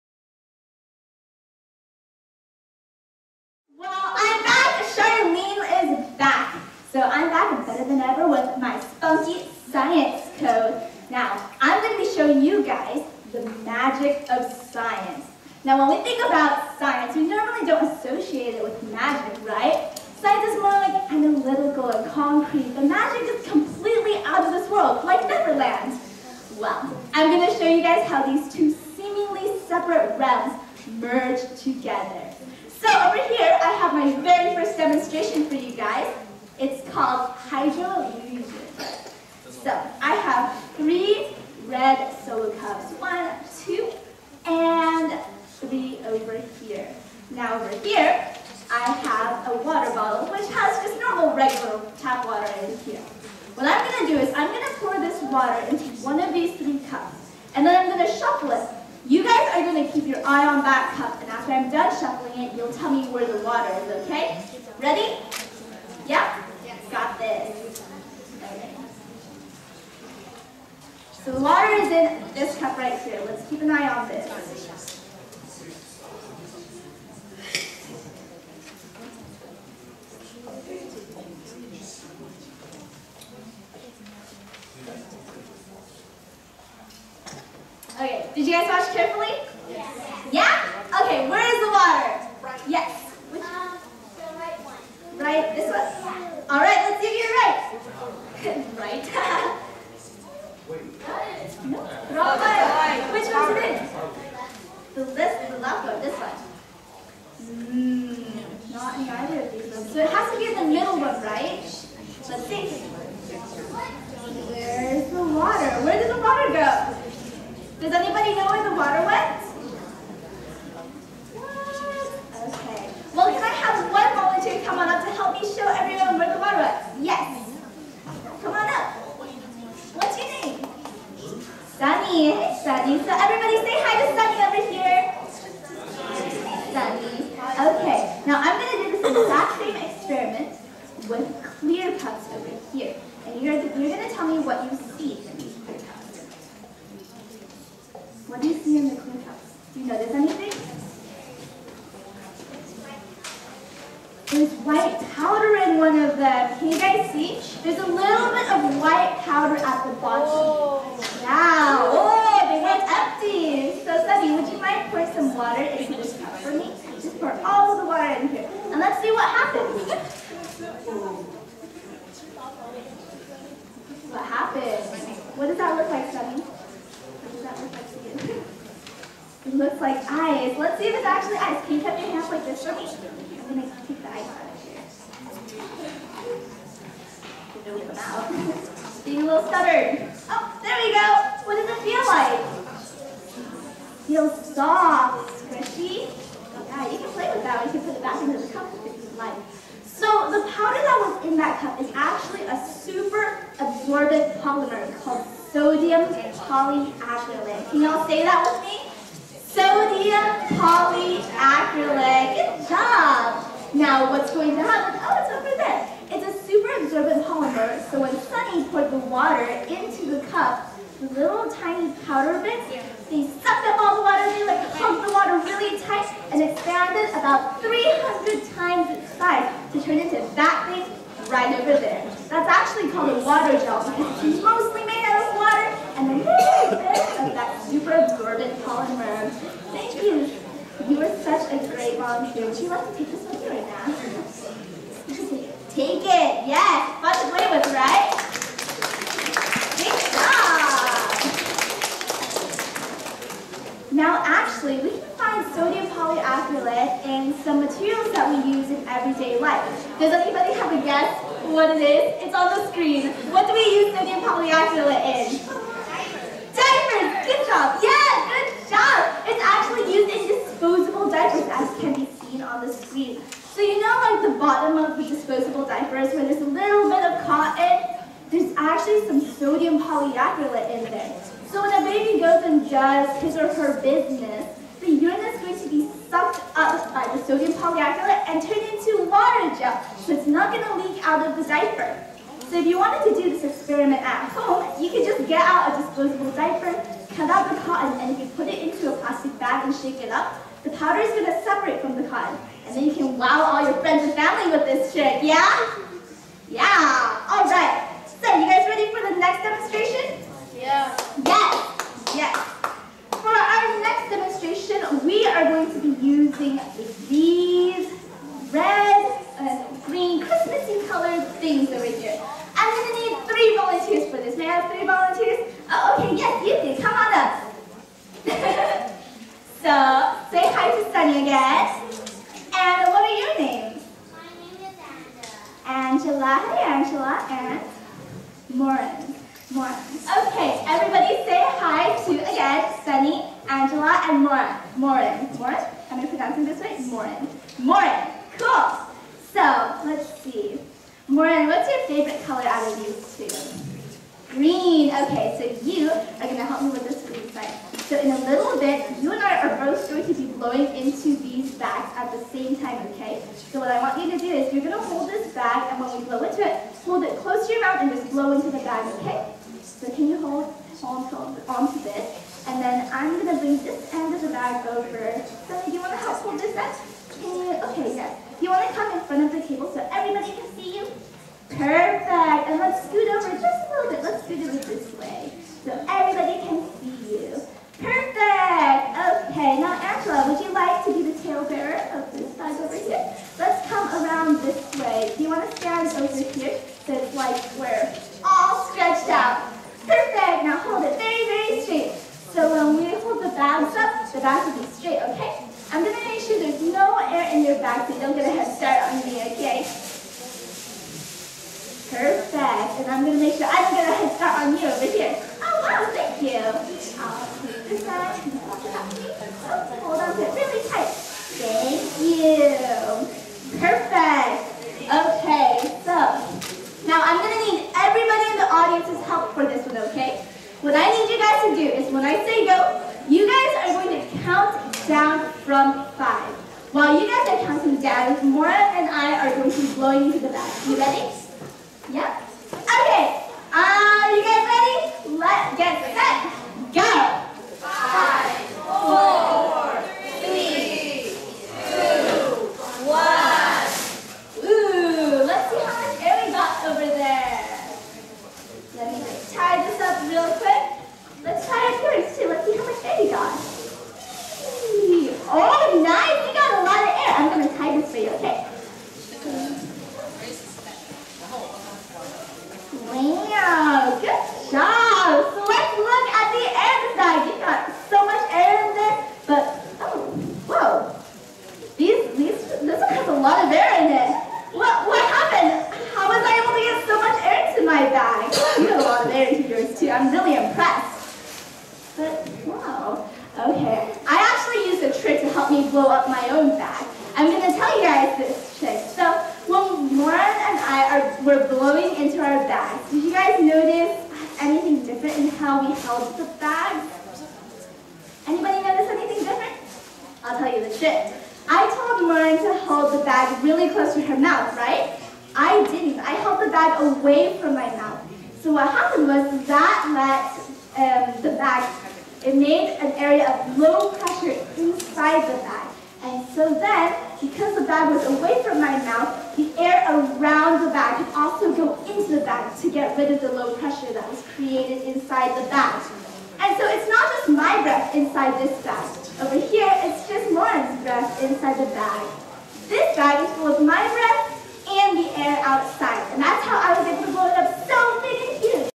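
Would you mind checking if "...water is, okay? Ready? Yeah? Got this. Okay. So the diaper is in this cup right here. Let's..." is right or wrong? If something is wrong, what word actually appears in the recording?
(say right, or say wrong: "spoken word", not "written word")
wrong: "water", not "diaper".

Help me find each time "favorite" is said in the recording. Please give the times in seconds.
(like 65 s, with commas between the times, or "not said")
351 s.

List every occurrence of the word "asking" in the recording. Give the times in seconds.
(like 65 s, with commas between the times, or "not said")
not said.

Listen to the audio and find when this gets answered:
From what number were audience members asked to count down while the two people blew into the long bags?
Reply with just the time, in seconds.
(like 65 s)
435 s.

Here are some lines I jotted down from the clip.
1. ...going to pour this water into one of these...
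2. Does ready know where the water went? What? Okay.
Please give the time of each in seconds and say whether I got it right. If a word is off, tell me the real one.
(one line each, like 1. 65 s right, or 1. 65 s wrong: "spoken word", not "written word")
1. 54 s right
2. 117 s wrong: "anybody", not "ready".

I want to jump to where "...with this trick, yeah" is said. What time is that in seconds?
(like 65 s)
304 s.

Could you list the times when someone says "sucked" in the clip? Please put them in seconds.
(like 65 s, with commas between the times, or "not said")
223 s, 286 s.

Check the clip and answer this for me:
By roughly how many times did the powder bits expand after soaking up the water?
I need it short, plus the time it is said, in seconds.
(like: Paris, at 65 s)
300, at 227 s.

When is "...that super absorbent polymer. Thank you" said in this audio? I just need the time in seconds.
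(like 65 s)
237 s.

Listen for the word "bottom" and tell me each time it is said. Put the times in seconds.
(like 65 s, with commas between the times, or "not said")
159 s, 274 s.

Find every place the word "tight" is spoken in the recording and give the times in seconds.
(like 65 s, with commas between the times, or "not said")
225 s, 420 s.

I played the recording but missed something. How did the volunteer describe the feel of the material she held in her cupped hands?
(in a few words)
Soft, squishy.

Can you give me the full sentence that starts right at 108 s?
Mm, not in either of these ones.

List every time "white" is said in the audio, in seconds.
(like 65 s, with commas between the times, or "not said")
154 s, 158 s.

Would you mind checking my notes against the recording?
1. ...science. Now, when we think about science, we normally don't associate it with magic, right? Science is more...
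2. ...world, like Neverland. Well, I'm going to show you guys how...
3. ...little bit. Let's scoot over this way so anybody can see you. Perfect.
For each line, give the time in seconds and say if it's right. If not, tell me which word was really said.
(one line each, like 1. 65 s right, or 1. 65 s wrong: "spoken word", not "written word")
1. 14 s right
2. 24 s right
3. 383 s wrong: "everybody", not "anybody".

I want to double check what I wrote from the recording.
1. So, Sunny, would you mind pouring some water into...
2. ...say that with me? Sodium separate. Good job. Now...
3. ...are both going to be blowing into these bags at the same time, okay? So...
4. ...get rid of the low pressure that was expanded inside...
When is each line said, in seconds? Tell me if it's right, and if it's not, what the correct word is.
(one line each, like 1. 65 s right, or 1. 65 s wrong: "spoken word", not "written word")
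1. 163 s right
2. 208 s wrong: "polyacrylate", not "separate"
3. 359 s right
4. 532 s wrong: "created", not "expanded".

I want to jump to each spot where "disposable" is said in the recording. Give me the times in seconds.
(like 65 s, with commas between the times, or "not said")
270 s, 275 s, 295 s.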